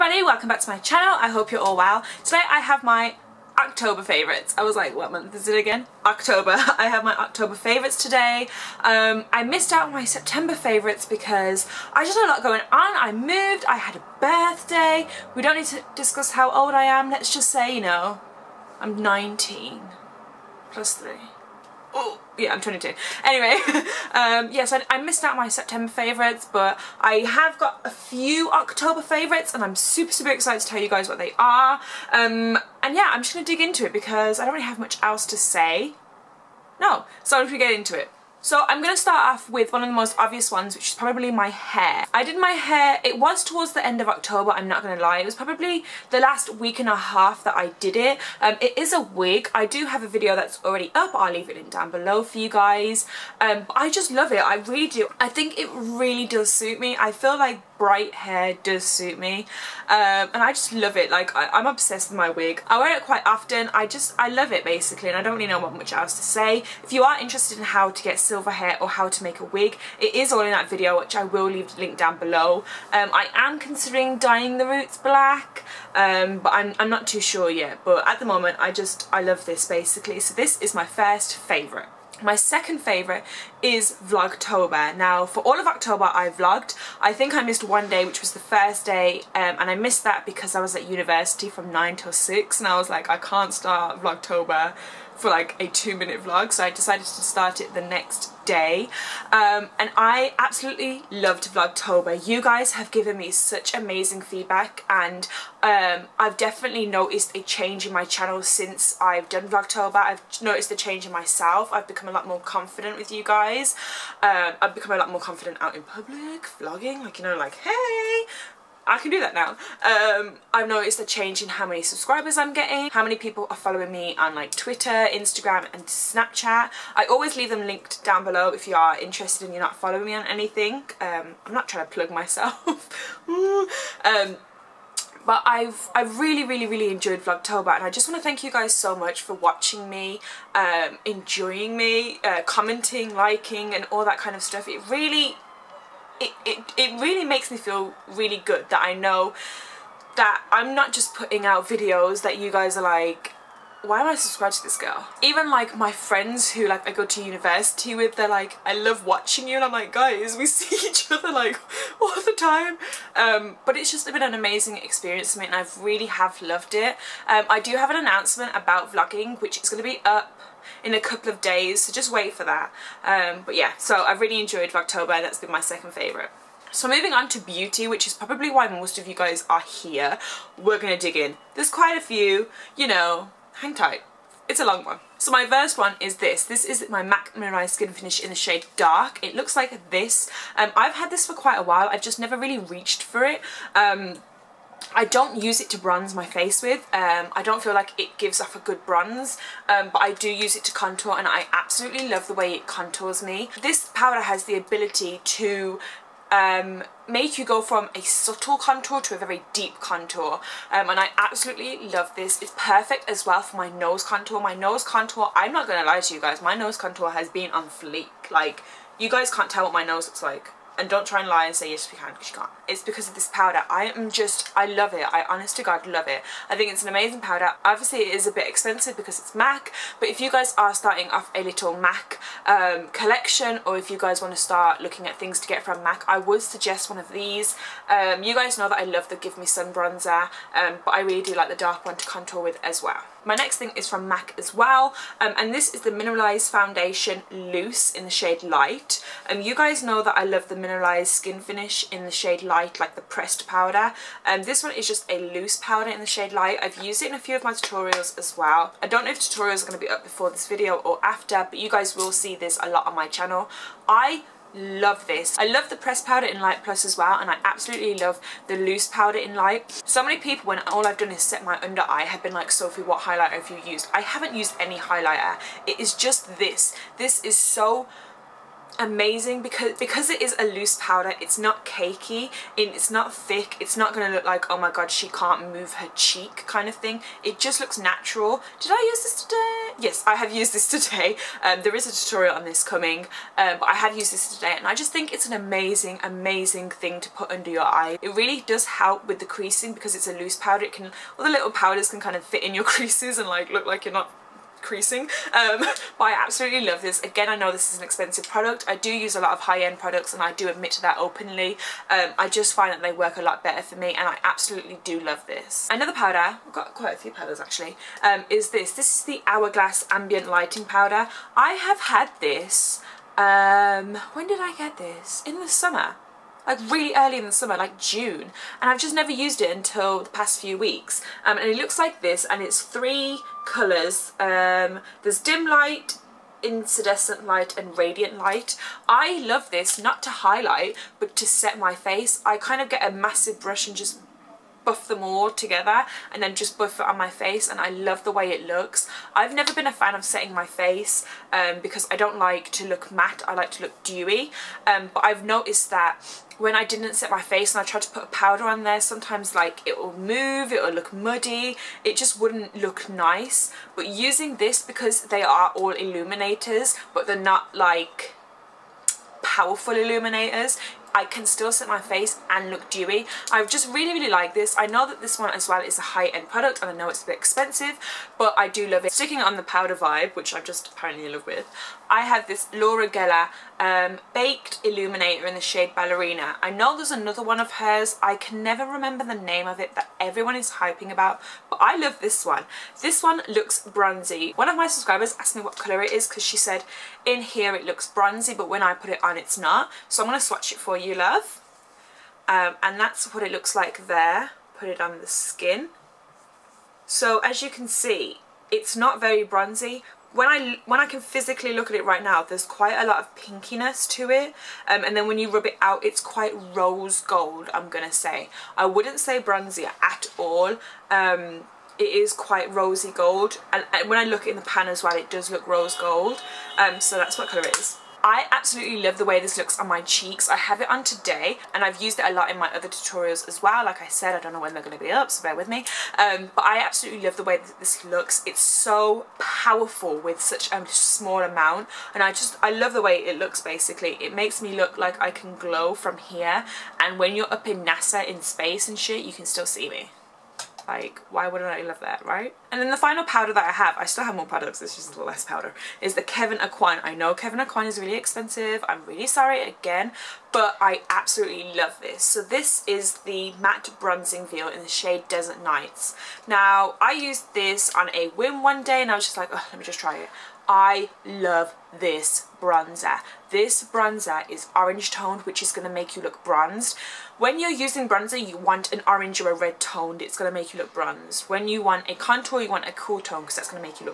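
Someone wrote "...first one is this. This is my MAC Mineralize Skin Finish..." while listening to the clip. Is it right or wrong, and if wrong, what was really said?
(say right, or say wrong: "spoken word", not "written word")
right.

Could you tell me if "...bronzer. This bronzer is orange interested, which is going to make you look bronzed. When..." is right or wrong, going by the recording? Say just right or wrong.
wrong.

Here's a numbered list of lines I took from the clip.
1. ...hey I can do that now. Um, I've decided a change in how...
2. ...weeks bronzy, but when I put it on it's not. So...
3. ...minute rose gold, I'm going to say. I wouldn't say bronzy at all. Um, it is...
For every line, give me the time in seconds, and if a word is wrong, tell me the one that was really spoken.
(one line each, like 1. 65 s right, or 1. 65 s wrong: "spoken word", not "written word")
1. 117 s wrong: "noticed", not "decided"
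2. 397 s wrong: "looks", not "weeks"
3. 416 s wrong: "quite", not "minute".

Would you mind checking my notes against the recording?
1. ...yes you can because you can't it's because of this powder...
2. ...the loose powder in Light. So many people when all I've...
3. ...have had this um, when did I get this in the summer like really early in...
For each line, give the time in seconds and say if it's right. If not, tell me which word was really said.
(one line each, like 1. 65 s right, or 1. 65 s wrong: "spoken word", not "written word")
1. 221 s right
2. 268 s right
3. 321 s right.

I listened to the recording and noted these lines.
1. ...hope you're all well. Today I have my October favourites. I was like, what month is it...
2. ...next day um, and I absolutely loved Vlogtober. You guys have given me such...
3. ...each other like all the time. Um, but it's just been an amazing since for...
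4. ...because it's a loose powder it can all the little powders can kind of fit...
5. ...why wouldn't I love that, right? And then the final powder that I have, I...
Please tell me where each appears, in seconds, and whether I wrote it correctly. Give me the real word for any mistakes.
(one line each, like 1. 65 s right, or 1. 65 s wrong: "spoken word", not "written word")
1. 1 s right
2. 97 s right
3. 160 s wrong: "experience", not "since"
4. 299 s right
5. 451 s right.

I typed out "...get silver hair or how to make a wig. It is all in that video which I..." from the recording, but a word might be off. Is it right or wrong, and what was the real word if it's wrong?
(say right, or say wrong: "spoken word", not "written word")
right.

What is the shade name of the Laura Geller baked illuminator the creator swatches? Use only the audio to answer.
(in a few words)
Ballerina.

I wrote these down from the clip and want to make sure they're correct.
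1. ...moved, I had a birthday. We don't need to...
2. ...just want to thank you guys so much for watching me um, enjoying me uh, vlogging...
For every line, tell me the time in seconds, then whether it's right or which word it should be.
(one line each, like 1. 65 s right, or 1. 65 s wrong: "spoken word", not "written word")
1. 13 s right
2. 137 s wrong: "commenting", not "vlogging".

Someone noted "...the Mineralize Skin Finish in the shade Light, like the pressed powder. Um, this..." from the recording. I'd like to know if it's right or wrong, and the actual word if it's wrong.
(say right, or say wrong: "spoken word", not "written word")
right.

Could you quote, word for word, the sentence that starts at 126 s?
I always leave them linked down below if you are interested and you're not following me on anything.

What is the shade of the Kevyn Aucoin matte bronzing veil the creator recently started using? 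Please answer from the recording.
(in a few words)
Desert Nights.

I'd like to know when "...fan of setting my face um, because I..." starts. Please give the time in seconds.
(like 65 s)
349 s.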